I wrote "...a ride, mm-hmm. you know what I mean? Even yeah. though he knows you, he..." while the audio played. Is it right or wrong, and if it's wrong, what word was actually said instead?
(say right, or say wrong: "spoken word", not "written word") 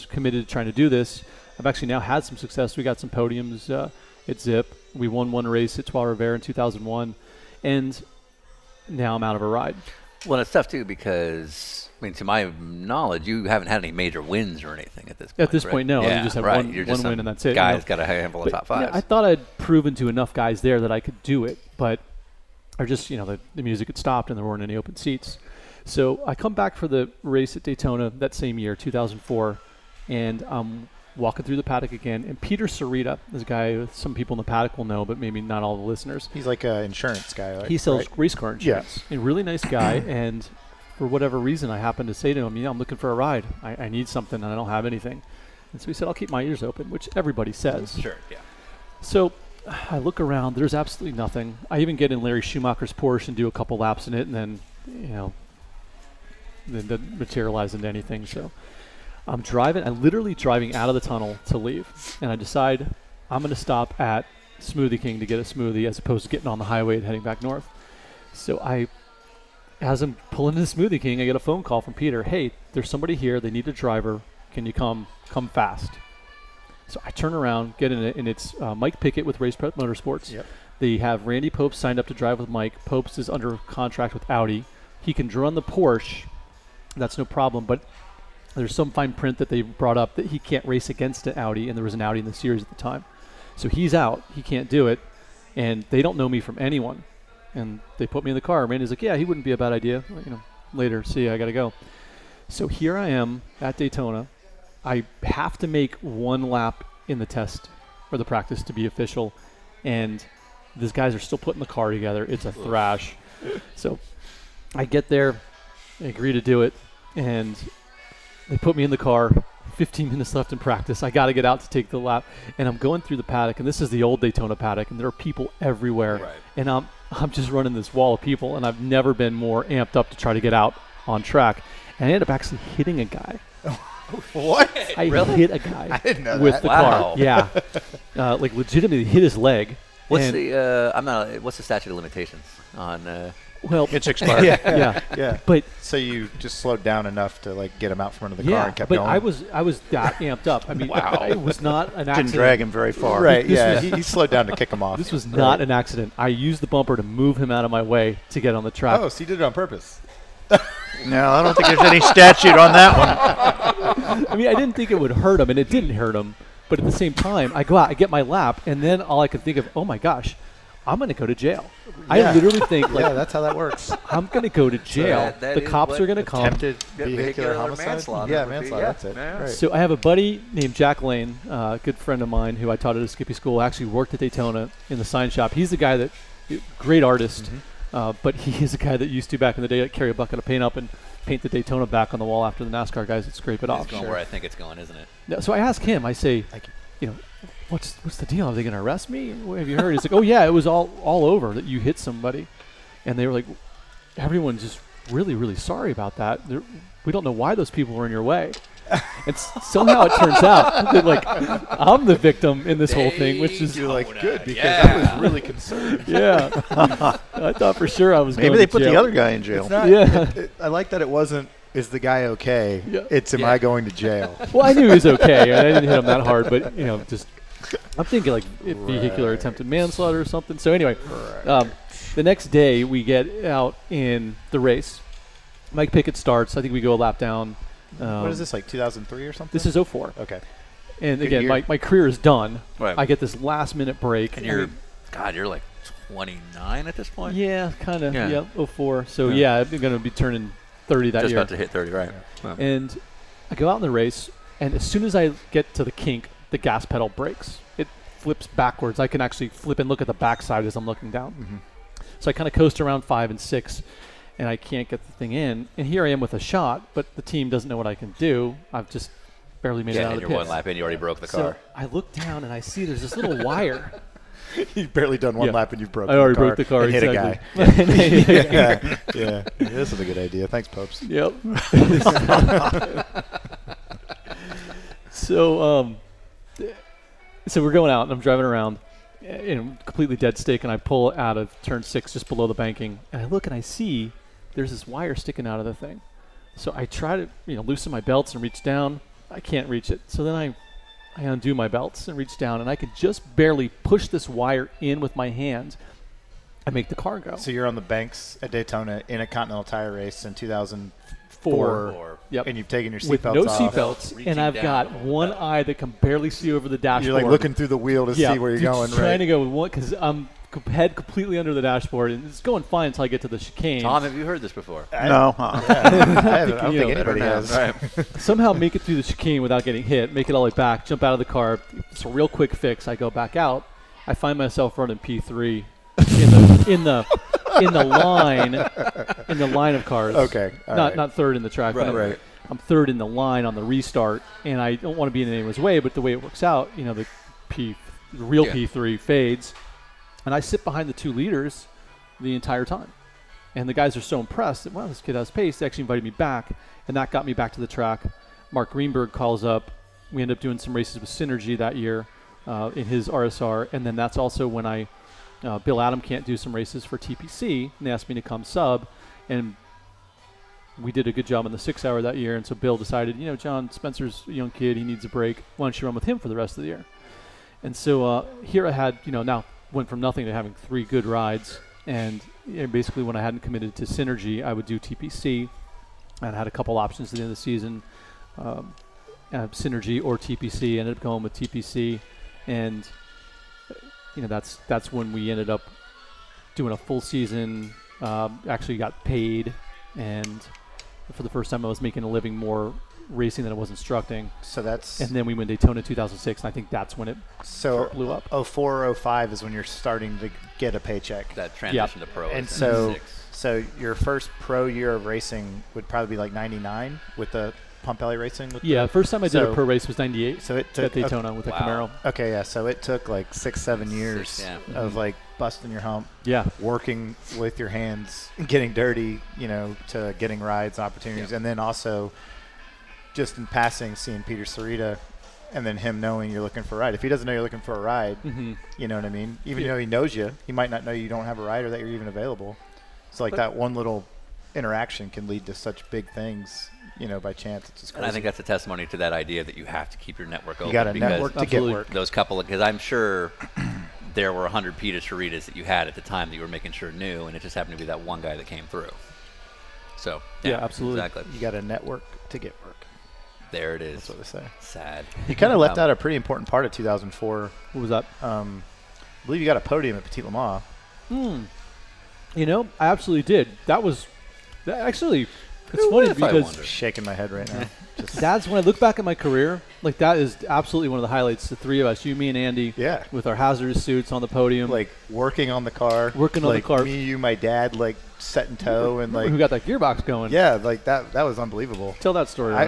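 right.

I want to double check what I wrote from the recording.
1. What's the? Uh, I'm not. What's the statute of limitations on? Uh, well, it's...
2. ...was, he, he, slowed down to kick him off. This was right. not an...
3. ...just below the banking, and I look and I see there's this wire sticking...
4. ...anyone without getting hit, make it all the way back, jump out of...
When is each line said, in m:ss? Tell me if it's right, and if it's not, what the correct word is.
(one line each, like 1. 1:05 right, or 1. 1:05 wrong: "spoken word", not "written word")
1. 2:20 right
2. 2:33 right
3. 4:52 right
4. 5:29 wrong: "chicane", not "anyone".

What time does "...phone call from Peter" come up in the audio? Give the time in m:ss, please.
1:11.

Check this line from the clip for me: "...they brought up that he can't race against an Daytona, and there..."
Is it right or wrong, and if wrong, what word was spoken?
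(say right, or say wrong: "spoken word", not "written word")
wrong: "Audi", not "Daytona".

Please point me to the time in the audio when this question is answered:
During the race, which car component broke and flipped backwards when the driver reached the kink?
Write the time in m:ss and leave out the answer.
4:16.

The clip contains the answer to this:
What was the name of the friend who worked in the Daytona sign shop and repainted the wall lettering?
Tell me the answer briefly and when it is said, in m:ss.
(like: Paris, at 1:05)
Jack Lane, at 3:00.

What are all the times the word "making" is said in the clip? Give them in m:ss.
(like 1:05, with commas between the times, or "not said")
6:41, 7:36.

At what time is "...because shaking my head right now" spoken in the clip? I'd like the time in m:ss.
7:56.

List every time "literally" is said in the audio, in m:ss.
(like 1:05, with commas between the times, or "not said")
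1:00, 2:52.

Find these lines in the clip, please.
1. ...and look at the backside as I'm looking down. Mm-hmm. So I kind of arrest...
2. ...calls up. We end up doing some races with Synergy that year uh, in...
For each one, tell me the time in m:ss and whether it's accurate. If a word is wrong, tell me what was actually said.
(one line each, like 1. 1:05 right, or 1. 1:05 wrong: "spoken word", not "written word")
1. 4:19 wrong: "coast", not "arrest"
2. 5:59 right.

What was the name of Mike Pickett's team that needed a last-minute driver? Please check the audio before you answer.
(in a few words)
Race Prep Motorsports.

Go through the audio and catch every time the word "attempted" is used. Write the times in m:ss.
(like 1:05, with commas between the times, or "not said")
2:56, 3:49.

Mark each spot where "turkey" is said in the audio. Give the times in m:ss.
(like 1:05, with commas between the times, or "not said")
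not said.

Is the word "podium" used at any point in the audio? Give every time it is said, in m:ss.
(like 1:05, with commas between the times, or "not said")
0:03, 7:49, 8:04.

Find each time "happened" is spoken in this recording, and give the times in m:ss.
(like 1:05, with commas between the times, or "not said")
0:41, 7:37.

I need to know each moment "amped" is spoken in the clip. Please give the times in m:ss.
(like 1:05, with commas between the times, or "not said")
2:09, 2:30.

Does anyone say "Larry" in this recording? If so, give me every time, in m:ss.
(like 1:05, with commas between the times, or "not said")
0:52.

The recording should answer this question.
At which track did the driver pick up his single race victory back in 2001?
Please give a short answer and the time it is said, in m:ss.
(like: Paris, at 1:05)
Trois Rivières, at 0:05.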